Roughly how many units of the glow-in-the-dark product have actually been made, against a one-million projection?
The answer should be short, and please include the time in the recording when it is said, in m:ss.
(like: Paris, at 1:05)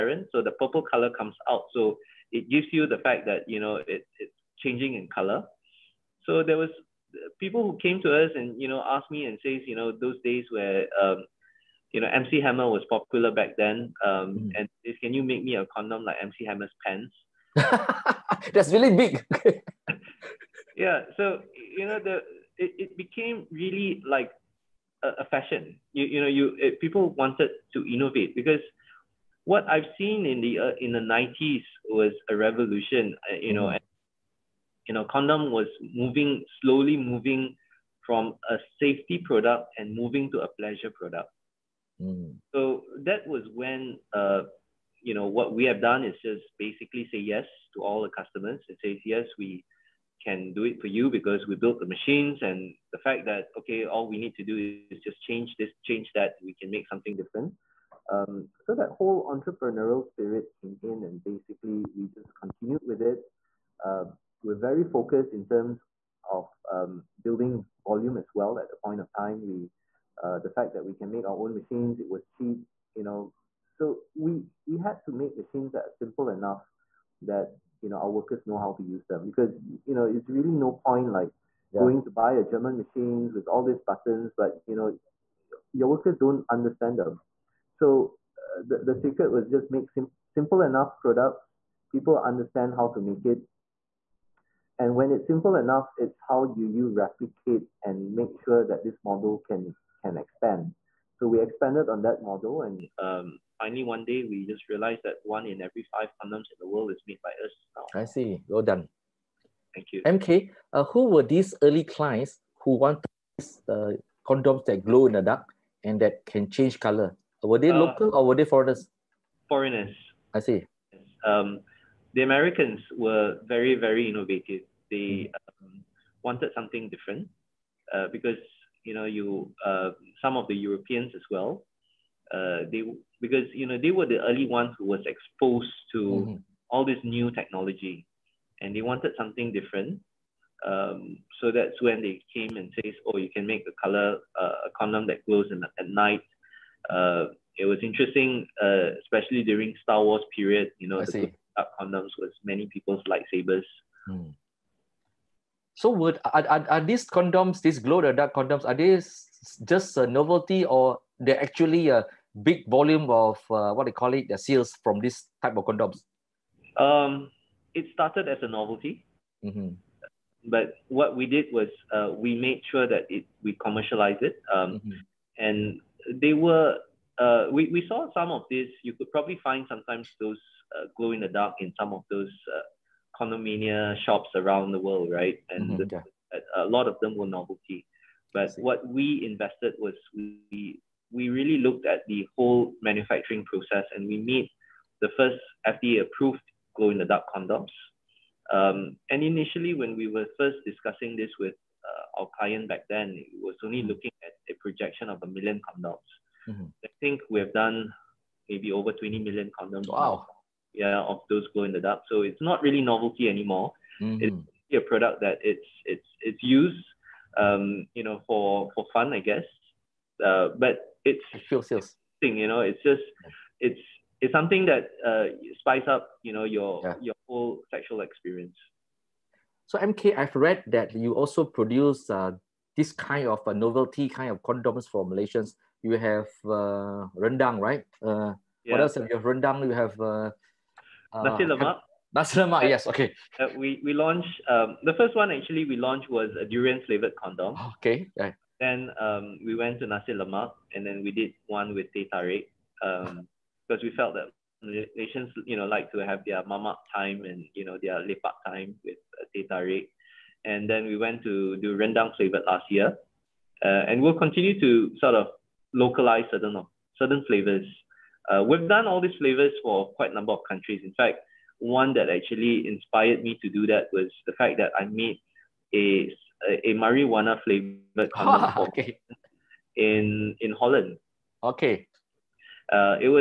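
over 20 million, at 3:28.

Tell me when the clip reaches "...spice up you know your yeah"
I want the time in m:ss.
3:45.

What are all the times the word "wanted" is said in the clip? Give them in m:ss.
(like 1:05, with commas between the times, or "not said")
0:27, 1:52, 2:06, 2:18.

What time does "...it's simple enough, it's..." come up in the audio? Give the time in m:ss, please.
1:35.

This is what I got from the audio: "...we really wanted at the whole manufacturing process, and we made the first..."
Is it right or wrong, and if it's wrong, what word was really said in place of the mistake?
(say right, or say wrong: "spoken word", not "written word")
wrong: "looked", not "wanted".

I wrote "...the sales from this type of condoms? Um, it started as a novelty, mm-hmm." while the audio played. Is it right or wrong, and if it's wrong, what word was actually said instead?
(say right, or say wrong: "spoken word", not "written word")
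right.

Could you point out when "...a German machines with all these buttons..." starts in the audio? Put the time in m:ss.
1:22.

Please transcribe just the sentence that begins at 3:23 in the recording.
looking at a projection of a million condoms.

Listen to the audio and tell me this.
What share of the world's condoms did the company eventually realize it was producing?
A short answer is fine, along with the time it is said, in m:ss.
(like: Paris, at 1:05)
one in every five, at 1:45.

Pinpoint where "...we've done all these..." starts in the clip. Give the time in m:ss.
4:28.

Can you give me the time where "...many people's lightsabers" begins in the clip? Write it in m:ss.
2:32.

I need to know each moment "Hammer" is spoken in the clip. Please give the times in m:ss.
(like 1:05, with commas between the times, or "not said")
0:12, 0:16.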